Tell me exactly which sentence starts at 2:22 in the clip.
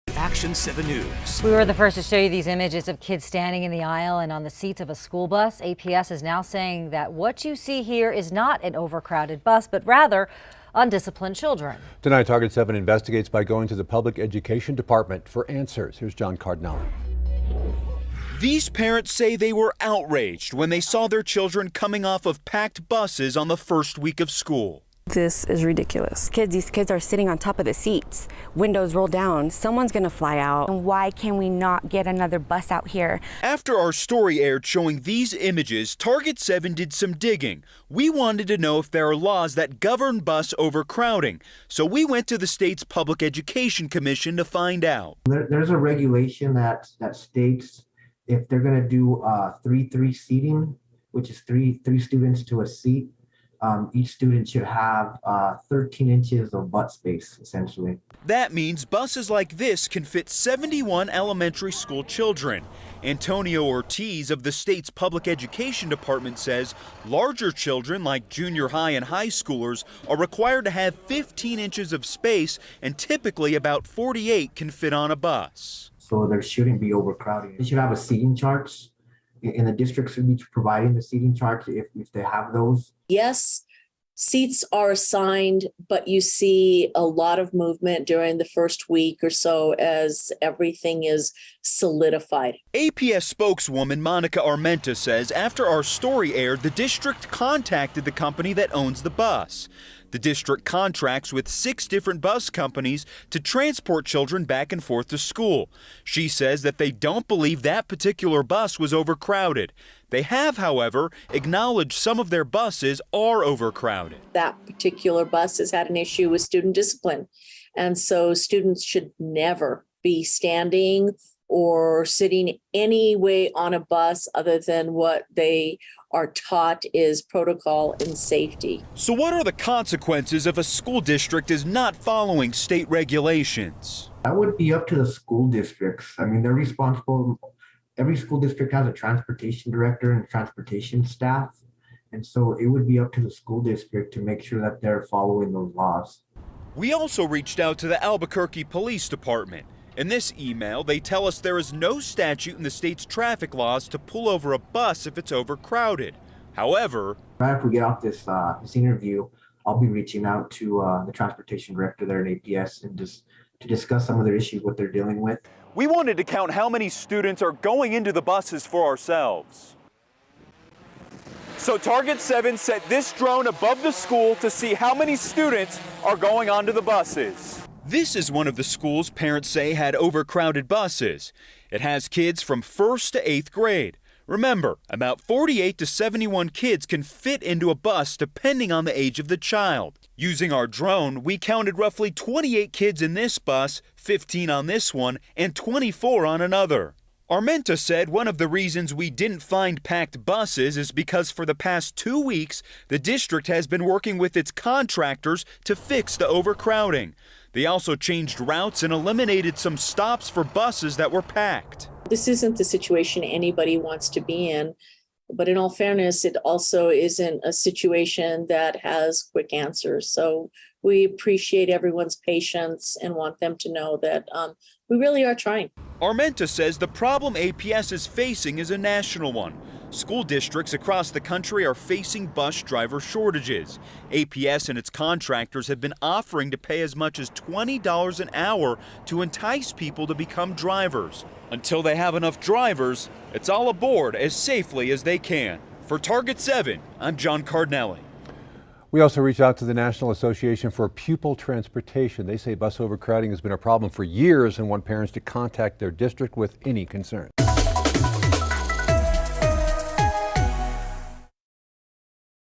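And so it would be up to the school district to make sure that they're following those laws.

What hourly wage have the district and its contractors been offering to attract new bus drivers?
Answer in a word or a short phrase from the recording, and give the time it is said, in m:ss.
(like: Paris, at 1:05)
$20 an hour, at 3:57.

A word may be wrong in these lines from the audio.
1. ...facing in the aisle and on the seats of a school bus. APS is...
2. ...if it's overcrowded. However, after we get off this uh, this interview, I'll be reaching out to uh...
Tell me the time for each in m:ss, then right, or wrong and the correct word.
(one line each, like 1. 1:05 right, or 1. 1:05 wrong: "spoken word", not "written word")
1. 0:03 wrong: "standing", not "facing"
2. 2:35 right.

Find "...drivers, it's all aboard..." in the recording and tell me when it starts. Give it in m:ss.
4:02.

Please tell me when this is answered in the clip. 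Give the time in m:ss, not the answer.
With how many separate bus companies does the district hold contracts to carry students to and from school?
1:41.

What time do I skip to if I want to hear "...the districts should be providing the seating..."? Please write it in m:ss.
1:19.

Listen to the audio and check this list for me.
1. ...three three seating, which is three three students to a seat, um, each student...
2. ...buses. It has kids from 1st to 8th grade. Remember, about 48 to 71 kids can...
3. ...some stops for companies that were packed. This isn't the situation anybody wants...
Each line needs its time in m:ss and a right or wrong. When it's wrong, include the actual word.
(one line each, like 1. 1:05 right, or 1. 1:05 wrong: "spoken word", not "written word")
1. 0:49 right
2. 3:00 right
3. 3:29 wrong: "buses", not "companies".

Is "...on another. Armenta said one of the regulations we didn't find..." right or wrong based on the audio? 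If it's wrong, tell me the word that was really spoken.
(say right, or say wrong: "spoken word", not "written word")
wrong: "reasons", not "regulations".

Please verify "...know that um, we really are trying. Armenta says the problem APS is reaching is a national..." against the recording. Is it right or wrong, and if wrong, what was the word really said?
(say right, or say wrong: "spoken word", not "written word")
wrong: "facing", not "reaching".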